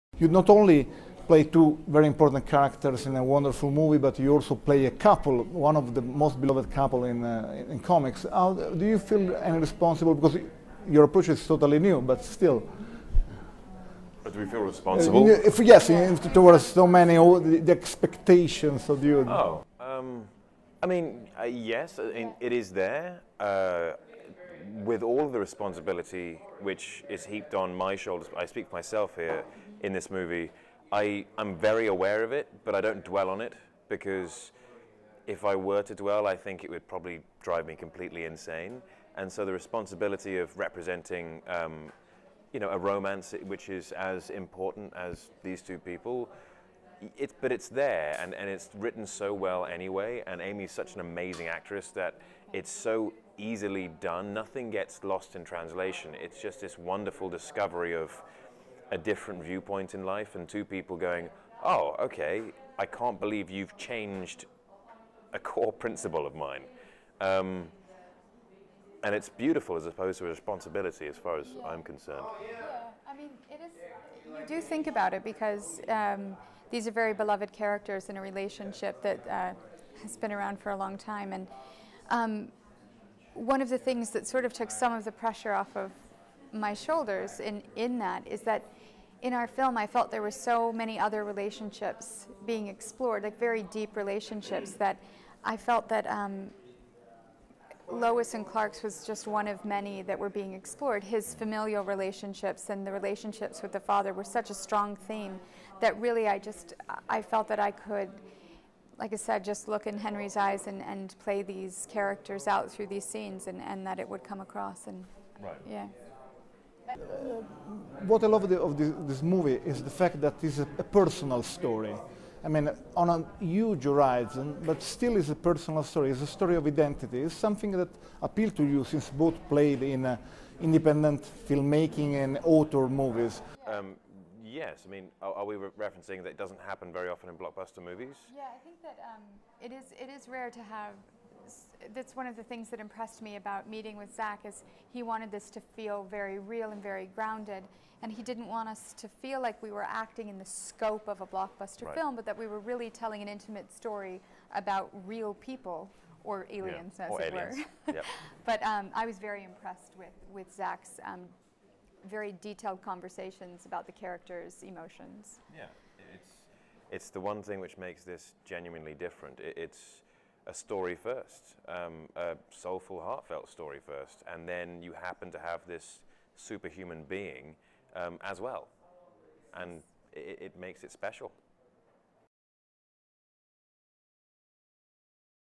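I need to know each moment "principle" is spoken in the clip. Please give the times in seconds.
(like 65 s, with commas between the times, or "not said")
65 s.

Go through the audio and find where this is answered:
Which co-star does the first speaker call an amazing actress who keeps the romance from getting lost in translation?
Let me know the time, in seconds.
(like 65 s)
50 s.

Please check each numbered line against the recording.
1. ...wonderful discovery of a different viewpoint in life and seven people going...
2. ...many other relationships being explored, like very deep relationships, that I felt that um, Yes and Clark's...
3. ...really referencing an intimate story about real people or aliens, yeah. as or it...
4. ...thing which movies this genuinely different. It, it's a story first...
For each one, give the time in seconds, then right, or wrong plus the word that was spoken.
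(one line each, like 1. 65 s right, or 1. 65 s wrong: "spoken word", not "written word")
1. 56 s wrong: "two", not "seven"
2. 90 s wrong: "Lois", not "Yes"
3. 152 s wrong: "telling", not "referencing"
4. 167 s wrong: "makes", not "movies".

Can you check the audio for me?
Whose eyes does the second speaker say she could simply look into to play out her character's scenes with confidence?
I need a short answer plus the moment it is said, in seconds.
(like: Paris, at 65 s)
Henry, at 109 s.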